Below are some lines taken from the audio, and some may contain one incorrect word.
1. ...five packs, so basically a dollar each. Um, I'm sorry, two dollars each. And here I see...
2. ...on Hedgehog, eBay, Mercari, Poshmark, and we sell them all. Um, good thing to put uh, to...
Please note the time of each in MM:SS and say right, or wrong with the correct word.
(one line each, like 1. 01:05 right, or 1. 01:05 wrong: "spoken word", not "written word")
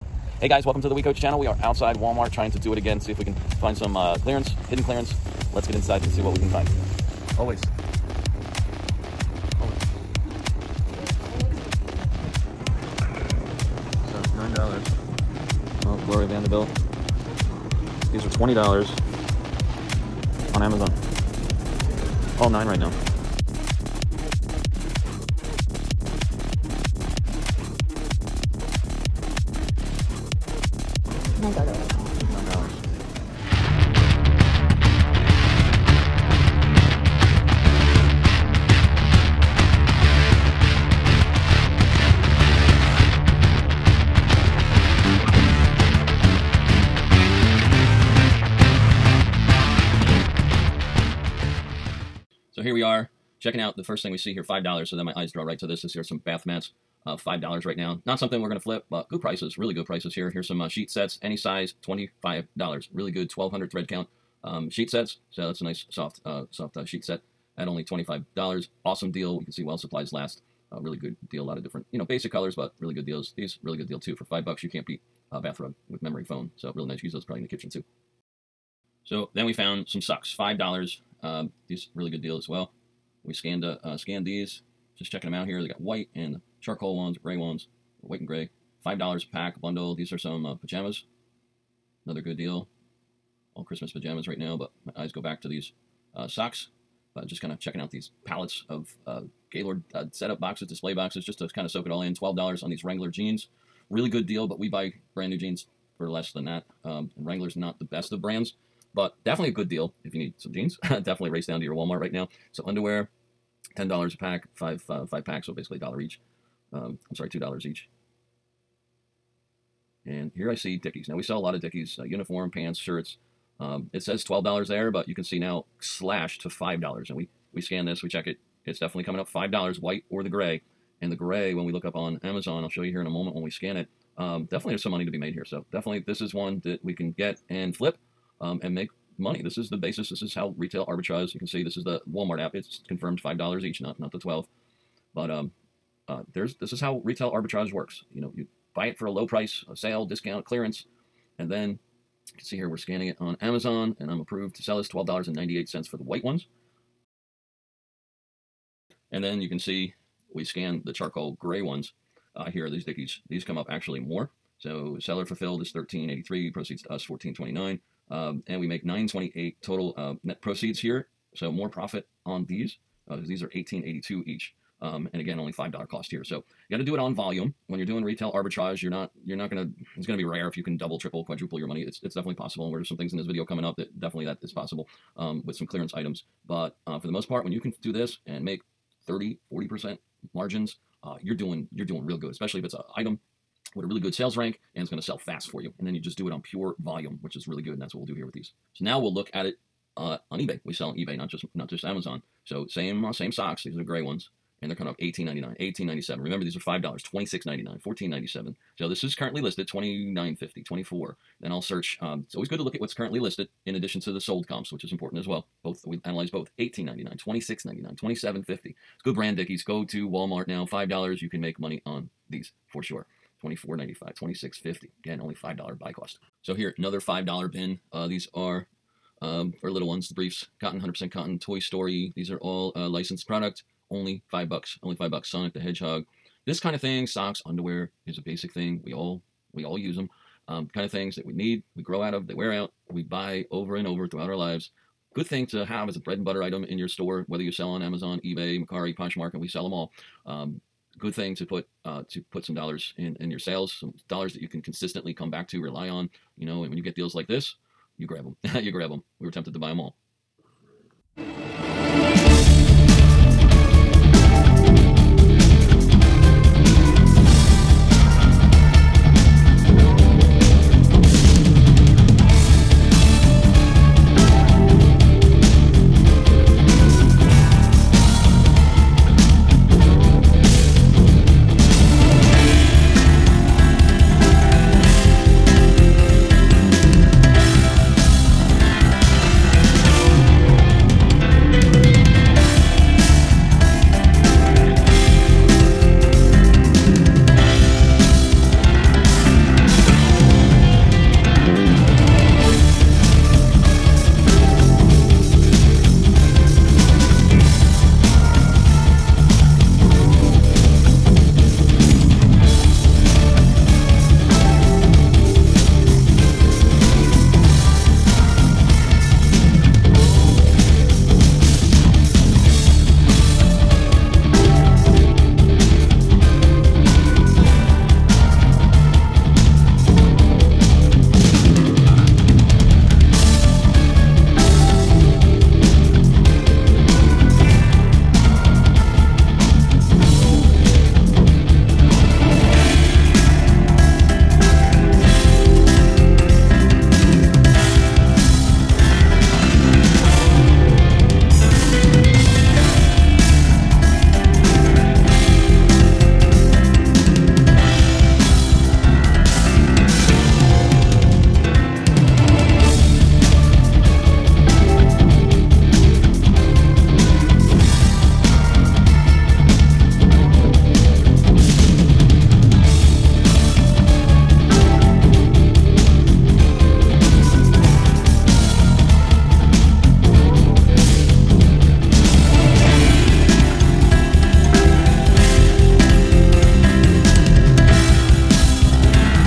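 1. 01:55 right
2. 04:07 wrong: "Amazon", not "Hedgehog".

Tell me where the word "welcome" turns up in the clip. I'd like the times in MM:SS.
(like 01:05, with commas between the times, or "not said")
00:00.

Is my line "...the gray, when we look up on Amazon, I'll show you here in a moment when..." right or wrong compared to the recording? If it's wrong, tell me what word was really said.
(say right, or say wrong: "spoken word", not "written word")
right.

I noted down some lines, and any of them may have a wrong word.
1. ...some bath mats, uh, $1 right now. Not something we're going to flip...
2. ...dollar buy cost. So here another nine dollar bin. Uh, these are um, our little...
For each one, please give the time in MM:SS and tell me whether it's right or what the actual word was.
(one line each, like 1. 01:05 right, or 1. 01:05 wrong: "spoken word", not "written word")
1. 00:56 wrong: "5", not "1"
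2. 03:45 wrong: "five", not "nine".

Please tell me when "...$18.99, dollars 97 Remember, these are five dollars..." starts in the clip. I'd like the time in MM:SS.
03:24.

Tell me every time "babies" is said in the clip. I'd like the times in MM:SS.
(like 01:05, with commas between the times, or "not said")
not said.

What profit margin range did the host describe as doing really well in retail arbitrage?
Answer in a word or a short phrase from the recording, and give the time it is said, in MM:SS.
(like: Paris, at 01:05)
30 to 40 percent, at 03:09.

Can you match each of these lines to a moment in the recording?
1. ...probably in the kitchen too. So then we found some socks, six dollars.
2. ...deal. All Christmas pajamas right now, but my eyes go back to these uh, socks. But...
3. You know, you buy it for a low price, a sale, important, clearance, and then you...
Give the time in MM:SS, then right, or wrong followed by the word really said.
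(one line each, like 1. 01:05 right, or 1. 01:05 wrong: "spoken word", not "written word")
1. 01:17 wrong: "five", not "six"
2. 01:32 right
3. 02:28 wrong: "discount", not "important".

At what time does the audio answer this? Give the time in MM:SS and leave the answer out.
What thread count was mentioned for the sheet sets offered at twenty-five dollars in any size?
01:03.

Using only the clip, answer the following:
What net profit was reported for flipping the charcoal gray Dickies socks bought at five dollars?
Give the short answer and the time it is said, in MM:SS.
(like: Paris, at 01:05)
$9.28, at 02:48.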